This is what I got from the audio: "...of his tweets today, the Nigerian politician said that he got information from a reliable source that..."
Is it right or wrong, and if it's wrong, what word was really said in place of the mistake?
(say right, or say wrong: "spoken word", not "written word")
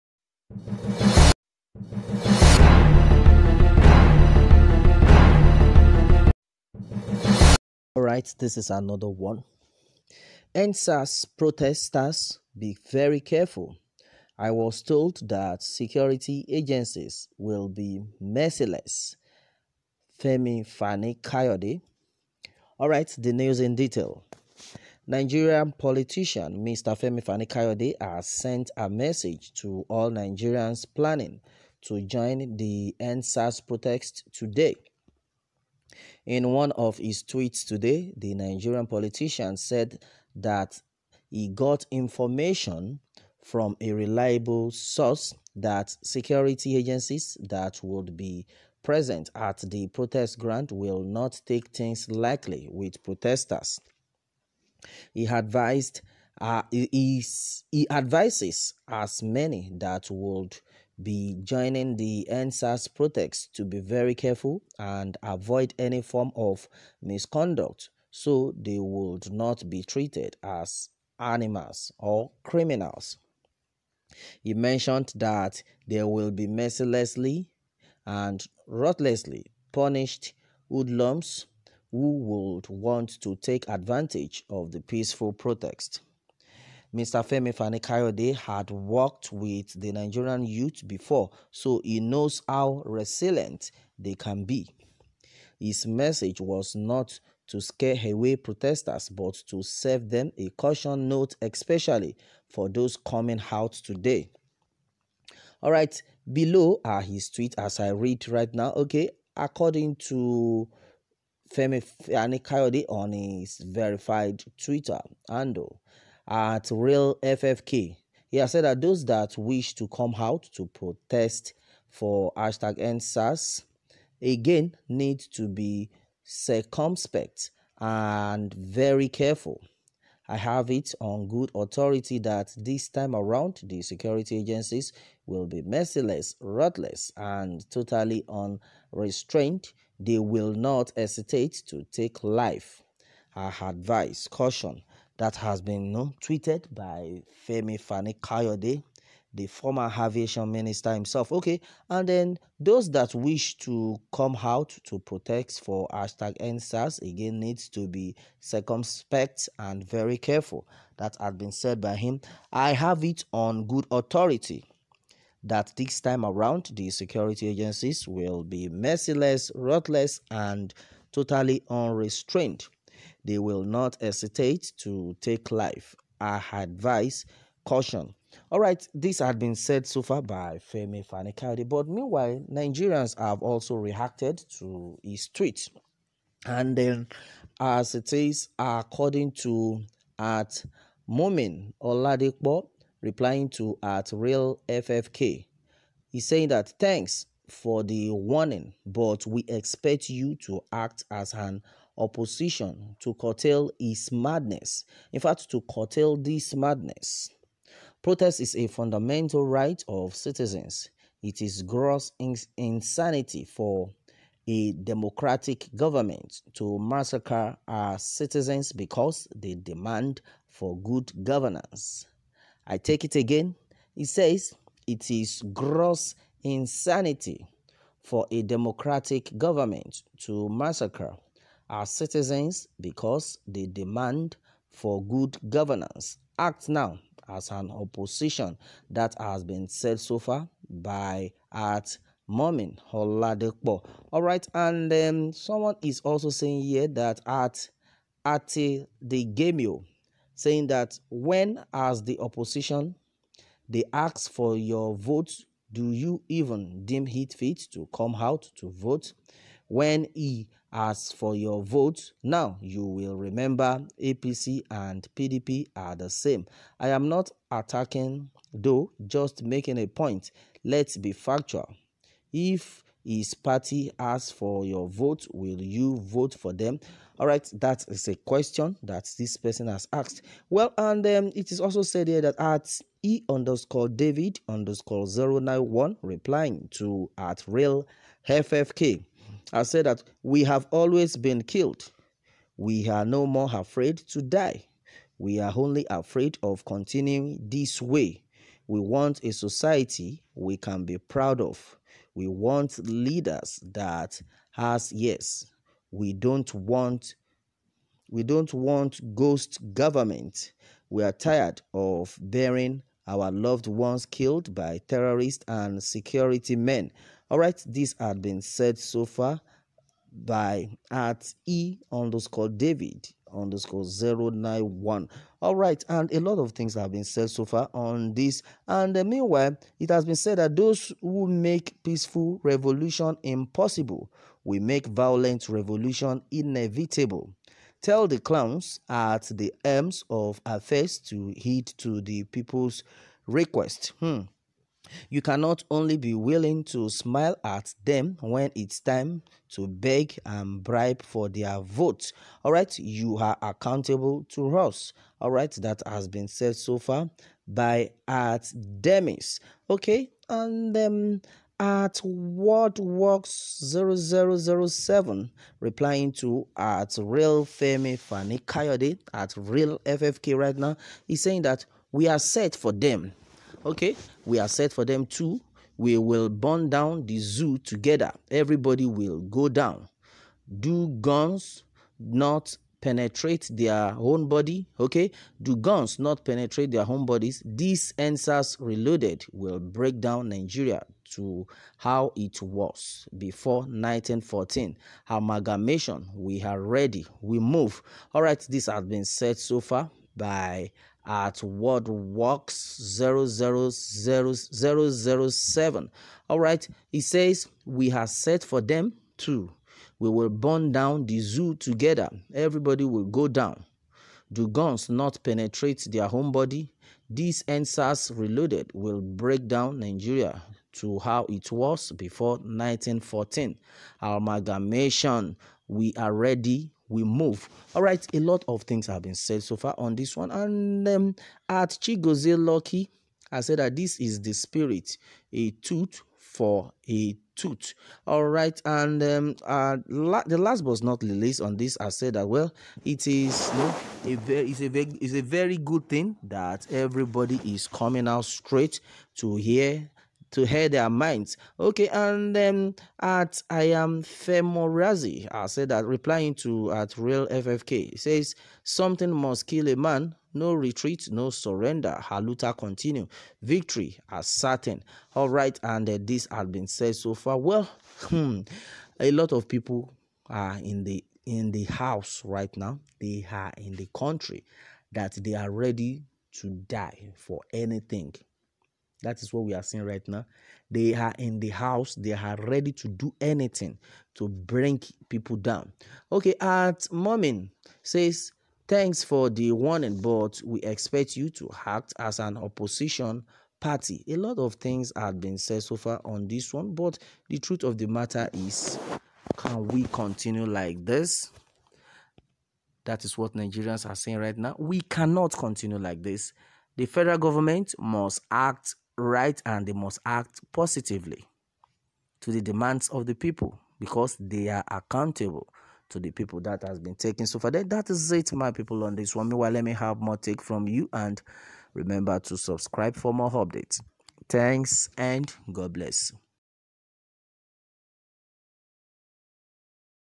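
right.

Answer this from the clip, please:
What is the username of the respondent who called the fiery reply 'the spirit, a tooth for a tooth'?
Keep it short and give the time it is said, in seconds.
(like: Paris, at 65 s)
Chigozie Lucky, at 431 s.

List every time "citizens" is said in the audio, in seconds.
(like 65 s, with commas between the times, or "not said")
210 s, 217 s, 231 s.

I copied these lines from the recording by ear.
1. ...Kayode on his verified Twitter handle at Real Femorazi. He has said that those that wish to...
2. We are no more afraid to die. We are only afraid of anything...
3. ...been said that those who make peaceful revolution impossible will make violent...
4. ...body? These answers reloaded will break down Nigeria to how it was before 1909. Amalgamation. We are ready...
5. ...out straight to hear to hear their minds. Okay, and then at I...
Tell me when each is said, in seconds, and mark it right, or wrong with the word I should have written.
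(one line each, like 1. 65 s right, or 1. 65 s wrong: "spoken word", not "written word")
1. 112 s wrong: "FFK", not "Femorazi"
2. 292 s wrong: "continuing", not "anything"
3. 330 s right
4. 416 s wrong: "1914", not "1909"
5. 448 s right.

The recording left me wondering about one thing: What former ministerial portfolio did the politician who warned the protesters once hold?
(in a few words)
Aviation.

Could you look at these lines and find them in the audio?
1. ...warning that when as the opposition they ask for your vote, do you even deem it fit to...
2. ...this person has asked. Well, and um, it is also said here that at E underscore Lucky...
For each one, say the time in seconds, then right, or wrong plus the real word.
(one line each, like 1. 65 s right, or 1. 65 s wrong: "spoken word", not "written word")
1. 250 s wrong: "saying", not "warning"
2. 279 s wrong: "David", not "Lucky".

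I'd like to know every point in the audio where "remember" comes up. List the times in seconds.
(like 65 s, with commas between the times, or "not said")
263 s, 521 s.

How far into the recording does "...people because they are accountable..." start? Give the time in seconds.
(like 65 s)
513 s.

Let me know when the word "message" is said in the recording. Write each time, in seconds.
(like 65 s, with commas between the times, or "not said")
28 s, 95 s.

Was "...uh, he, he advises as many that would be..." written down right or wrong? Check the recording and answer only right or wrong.
right.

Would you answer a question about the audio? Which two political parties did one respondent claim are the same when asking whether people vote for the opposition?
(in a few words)
APC and PDP.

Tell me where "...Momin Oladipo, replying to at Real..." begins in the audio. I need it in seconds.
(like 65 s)
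191 s.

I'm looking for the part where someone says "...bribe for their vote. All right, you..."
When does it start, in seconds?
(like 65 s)
350 s.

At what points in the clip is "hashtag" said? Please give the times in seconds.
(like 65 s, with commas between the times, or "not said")
122 s, 155 s.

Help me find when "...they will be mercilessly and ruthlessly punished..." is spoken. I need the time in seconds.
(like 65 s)
75 s.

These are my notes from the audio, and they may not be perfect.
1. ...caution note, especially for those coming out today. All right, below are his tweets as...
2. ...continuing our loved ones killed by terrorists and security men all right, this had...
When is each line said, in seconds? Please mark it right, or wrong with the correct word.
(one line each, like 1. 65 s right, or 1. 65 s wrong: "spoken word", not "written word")
1. 100 s right
2. 312 s wrong: "bearing", not "continuing".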